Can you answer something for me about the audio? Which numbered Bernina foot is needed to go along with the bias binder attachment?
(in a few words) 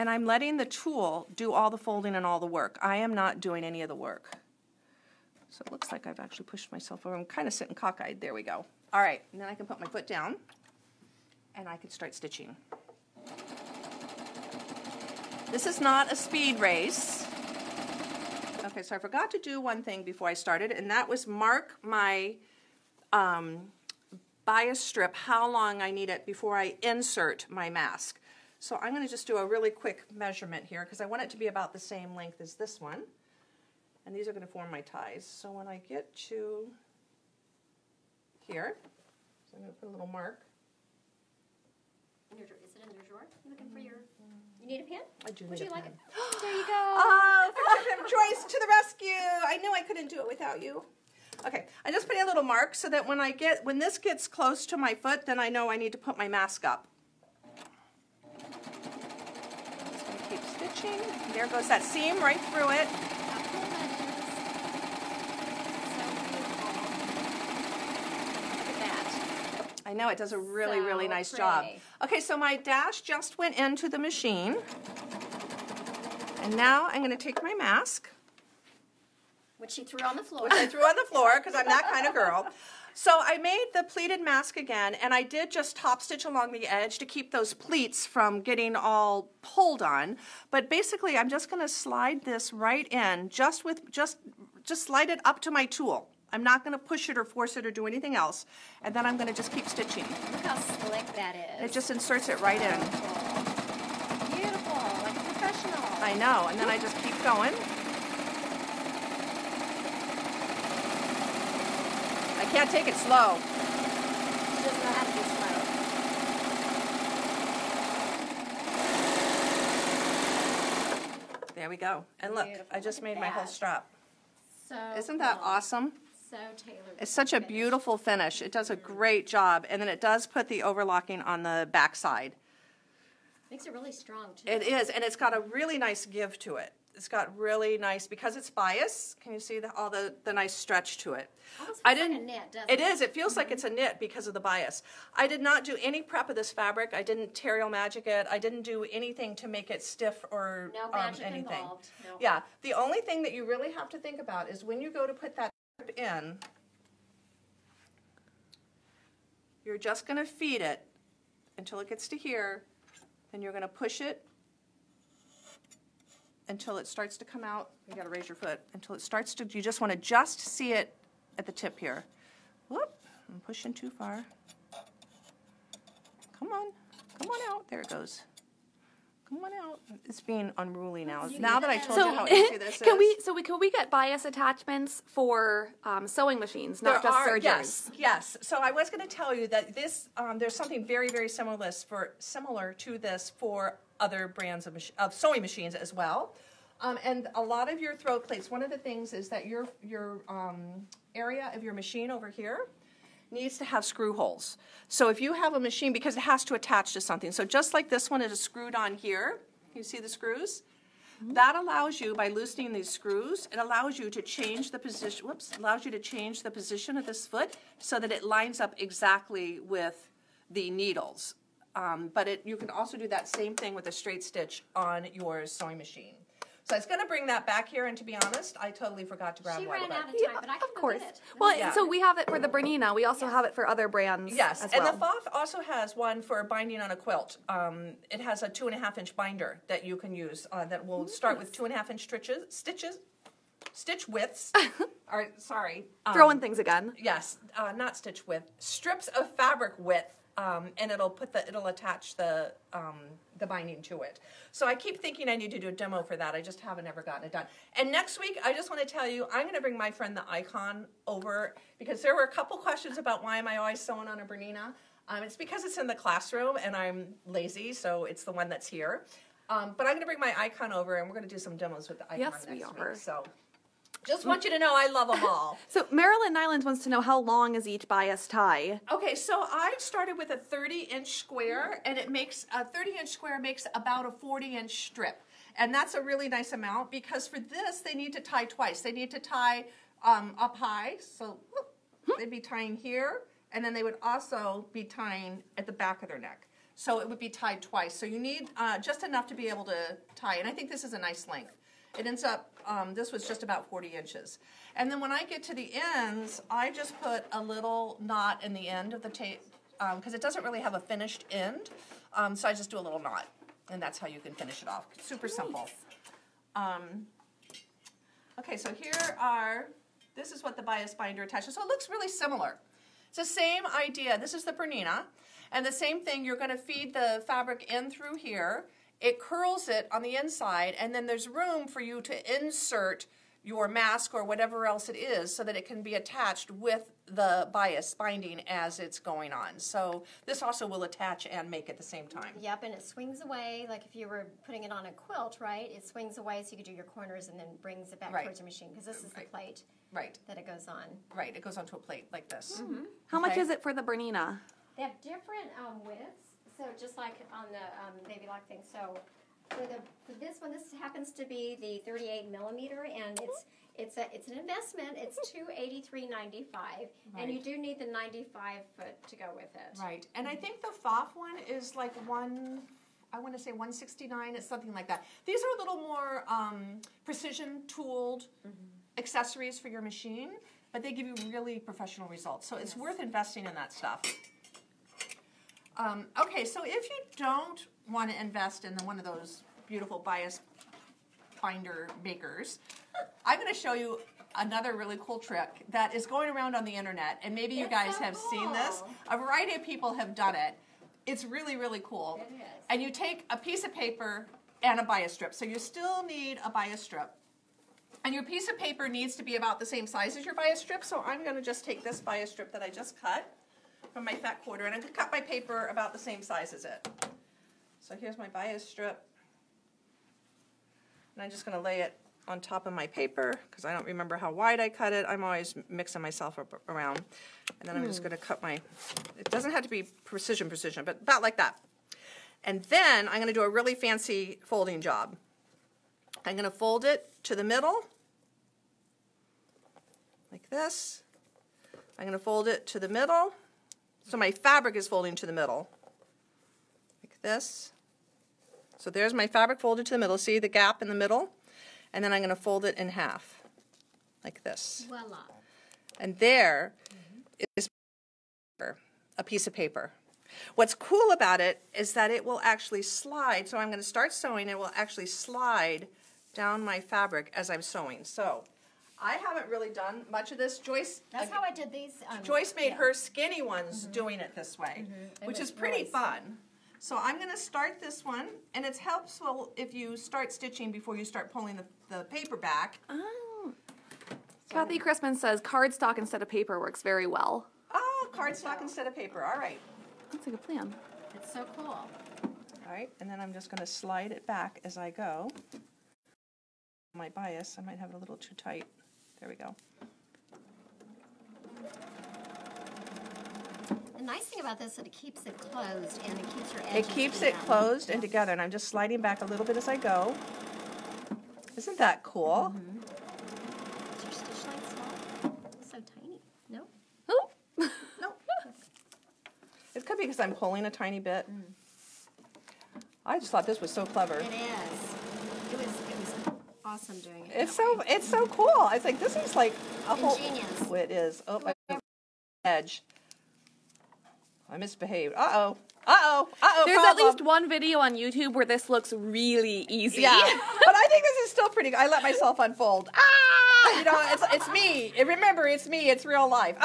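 95 foot.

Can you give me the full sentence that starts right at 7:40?
What's cool about it is that it will actually slide.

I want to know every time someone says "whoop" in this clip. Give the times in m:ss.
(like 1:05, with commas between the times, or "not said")
2:52, 3:35, 4:51.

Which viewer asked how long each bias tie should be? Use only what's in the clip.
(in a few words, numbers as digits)
Marilyn Nylands.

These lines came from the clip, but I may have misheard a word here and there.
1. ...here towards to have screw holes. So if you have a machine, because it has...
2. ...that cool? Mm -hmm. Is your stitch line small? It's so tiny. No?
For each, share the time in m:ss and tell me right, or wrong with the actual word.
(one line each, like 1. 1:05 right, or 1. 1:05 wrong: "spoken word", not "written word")
1. 3:22 wrong: "needs", not "towards"
2. 8:31 right.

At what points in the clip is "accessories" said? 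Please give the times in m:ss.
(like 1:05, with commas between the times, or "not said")
6:19.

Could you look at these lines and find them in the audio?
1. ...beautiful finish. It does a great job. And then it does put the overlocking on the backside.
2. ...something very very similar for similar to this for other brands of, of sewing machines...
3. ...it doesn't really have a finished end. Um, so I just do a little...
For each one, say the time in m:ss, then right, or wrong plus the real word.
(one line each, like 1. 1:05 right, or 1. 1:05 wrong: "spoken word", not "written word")
1. 2:07 right
2. 3:10 right
3. 5:10 right.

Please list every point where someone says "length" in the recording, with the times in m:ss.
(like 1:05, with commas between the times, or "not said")
0:32, 5:01.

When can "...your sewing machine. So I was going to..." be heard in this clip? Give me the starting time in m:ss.
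3:45.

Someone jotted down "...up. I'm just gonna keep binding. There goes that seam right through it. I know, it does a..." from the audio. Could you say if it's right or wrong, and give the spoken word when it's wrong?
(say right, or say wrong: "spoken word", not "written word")
wrong: "stitching", not "binding".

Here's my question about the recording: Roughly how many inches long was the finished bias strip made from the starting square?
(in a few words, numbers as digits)
40 inches.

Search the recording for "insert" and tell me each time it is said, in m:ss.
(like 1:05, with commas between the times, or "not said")
0:26, 1:41, 5:32.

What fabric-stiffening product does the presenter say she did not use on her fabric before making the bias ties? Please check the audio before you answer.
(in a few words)
Terial Magic.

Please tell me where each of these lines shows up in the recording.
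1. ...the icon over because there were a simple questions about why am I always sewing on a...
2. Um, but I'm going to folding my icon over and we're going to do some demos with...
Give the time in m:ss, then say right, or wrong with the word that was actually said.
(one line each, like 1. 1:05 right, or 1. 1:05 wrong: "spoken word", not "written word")
1. 4:20 wrong: "couple", not "simple"
2. 4:29 wrong: "bring", not "folding".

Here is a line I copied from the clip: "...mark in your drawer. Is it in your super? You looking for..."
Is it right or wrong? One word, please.
wrong.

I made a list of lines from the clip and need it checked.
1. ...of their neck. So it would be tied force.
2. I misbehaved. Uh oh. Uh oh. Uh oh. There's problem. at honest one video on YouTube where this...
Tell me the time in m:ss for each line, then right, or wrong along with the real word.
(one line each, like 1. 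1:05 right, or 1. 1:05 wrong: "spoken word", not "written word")
1. 4:56 wrong: "twice", not "force"
2. 8:54 wrong: "least", not "honest".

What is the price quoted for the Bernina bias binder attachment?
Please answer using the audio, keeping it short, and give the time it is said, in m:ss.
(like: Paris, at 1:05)
283.95, at 6:05.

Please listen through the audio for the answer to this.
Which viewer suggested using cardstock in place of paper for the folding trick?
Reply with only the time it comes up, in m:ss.
8:04.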